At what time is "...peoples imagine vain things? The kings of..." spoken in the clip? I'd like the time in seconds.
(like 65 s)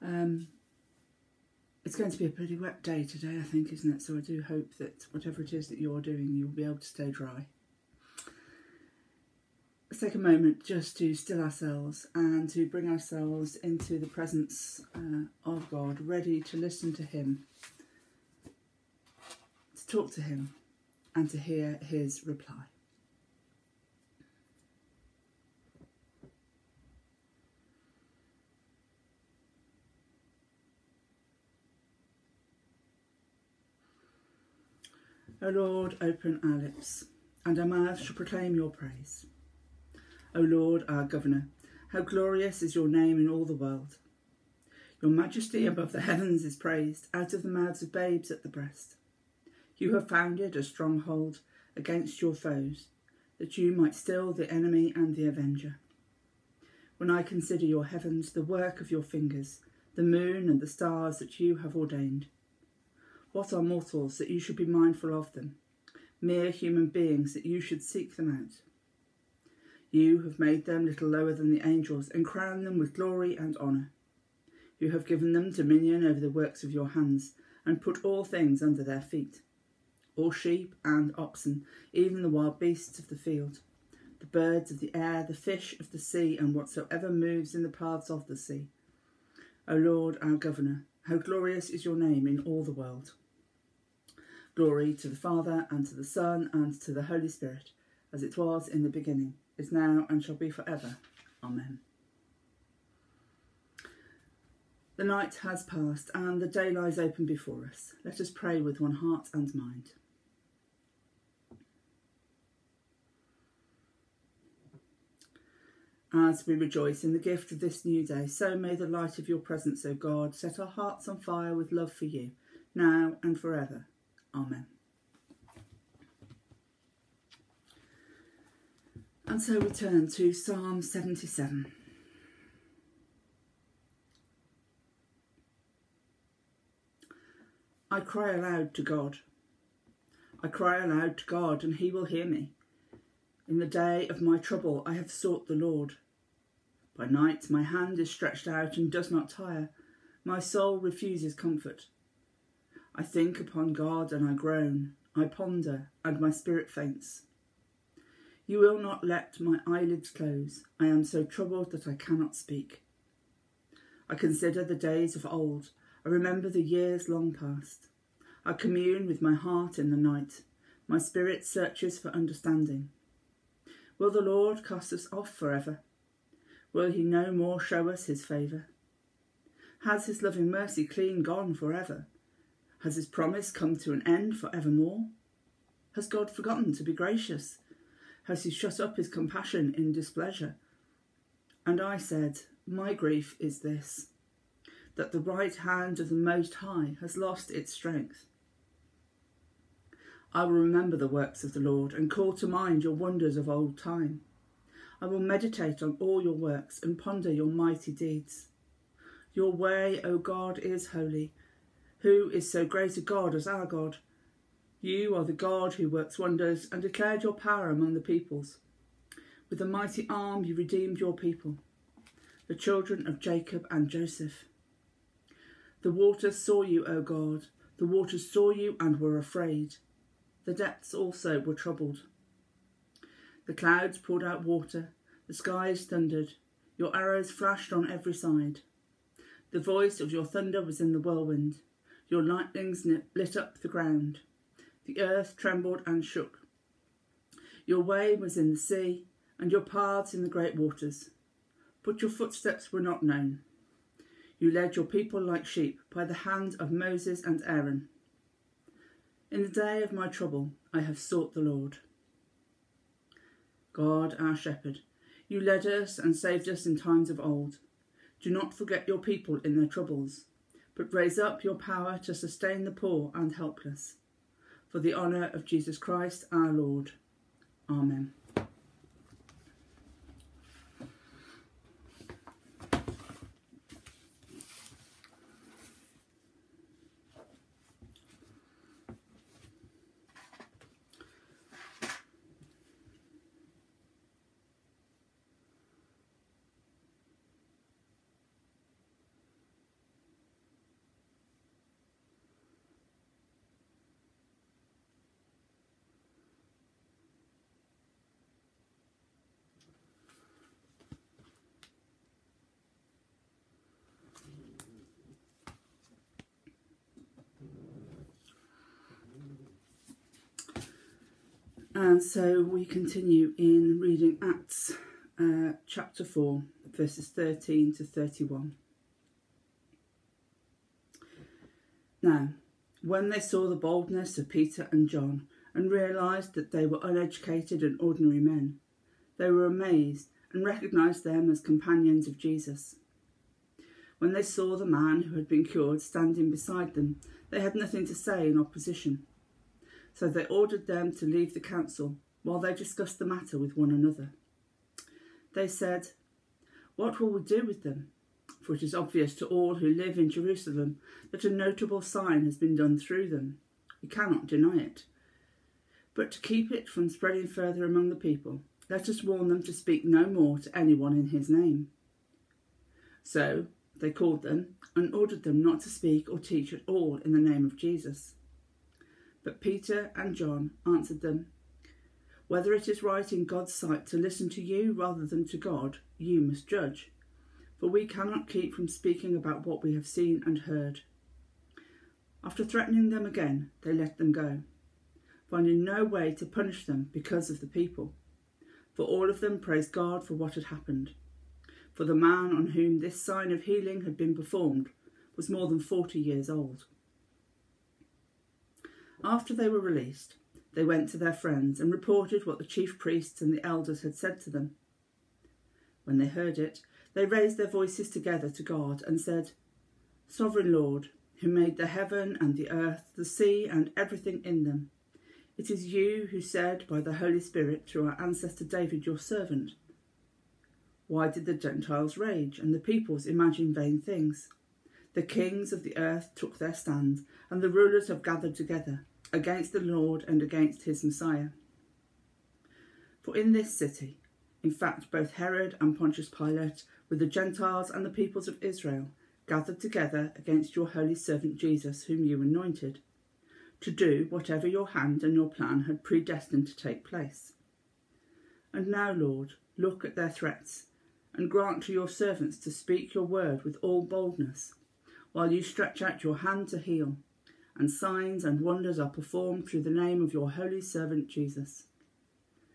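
432 s.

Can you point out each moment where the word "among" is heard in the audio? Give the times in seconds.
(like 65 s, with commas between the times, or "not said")
217 s, 367 s.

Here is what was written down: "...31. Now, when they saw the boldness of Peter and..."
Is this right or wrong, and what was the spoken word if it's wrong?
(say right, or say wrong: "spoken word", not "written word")
right.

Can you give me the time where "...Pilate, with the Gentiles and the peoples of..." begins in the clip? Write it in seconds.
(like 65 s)
446 s.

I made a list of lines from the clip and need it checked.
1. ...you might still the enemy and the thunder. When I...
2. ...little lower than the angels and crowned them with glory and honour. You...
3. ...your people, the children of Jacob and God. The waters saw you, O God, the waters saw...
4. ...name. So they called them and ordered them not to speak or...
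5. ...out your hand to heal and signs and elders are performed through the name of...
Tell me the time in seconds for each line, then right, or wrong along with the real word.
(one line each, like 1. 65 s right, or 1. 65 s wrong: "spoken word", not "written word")
1. 53 s wrong: "avenger", not "thunder"
2. 70 s right
3. 221 s wrong: "Joseph", not "God"
4. 371 s right
5. 465 s wrong: "wonders", not "elders".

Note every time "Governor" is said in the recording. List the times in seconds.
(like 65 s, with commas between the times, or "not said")
41 s, 90 s.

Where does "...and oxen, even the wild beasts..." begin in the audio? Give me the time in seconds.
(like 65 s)
80 s.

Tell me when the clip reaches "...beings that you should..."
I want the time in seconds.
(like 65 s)
66 s.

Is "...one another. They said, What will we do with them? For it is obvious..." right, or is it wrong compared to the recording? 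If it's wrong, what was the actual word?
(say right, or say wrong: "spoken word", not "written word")
right.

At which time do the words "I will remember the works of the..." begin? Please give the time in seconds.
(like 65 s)
200 s.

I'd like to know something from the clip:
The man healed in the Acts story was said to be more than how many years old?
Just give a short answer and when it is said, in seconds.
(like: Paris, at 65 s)
40, at 405 s.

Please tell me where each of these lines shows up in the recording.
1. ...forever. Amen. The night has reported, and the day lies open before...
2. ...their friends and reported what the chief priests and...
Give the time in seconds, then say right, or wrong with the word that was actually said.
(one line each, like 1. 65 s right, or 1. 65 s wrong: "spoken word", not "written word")
1. 100 s wrong: "passed", not "reported"
2. 410 s right.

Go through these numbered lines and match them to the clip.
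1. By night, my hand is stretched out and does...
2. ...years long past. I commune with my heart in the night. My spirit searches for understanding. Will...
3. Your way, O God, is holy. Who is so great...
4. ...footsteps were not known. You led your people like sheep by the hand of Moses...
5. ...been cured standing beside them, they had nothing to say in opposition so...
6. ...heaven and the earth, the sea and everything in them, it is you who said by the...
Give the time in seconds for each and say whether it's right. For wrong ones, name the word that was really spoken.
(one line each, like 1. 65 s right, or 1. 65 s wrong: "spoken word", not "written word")
1. 146 s right
2. 166 s right
3. 209 s right
4. 252 s right
5. 345 s right
6. 421 s right.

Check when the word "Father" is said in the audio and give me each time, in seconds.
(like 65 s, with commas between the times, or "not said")
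95 s.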